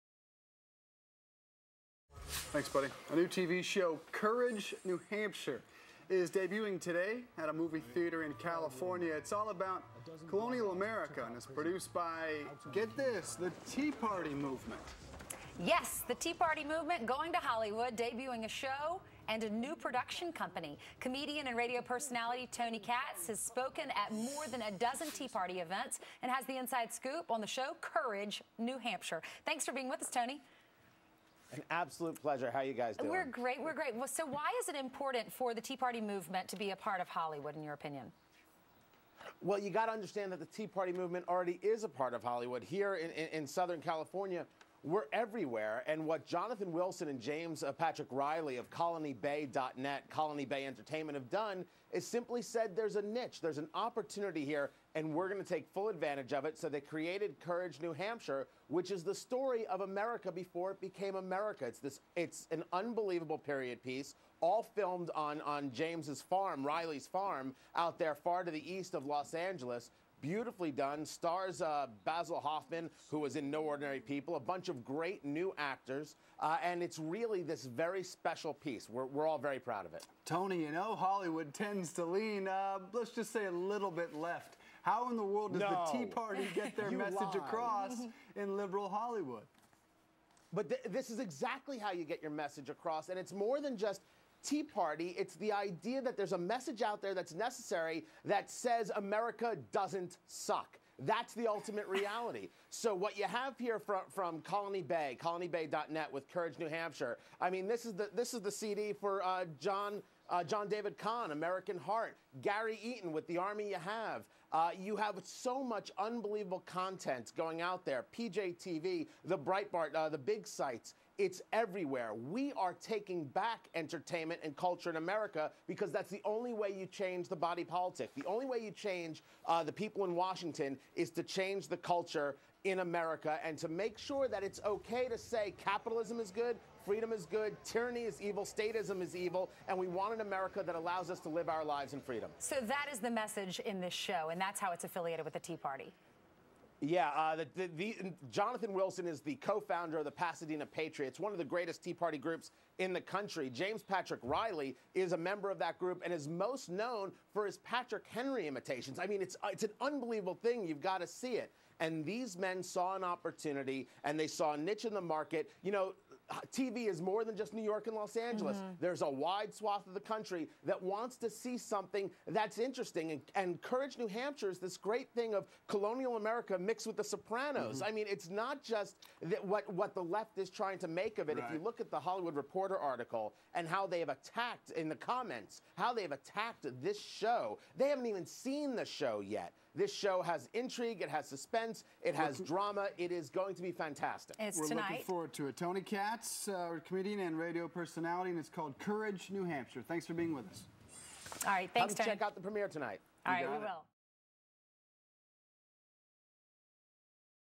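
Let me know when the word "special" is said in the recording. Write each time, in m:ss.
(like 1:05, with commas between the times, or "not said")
1:18.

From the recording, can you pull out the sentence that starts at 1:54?
Uh, you have so much unbelievable content going out there.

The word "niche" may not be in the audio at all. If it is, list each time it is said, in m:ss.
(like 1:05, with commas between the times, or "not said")
0:53, 2:44.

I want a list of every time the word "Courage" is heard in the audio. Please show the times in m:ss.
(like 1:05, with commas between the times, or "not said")
0:04, 0:27, 0:57, 1:46, 2:53, 3:18.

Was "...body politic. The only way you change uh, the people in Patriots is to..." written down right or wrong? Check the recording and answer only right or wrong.
wrong.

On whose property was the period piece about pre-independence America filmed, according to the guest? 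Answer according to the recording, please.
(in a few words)
Riley's farm.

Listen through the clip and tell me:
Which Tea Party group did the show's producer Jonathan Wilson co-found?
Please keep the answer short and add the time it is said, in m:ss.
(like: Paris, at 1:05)
Pasadena Patriots, at 2:30.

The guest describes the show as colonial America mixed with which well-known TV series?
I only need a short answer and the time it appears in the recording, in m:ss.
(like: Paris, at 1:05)
The Sopranos, at 2:56.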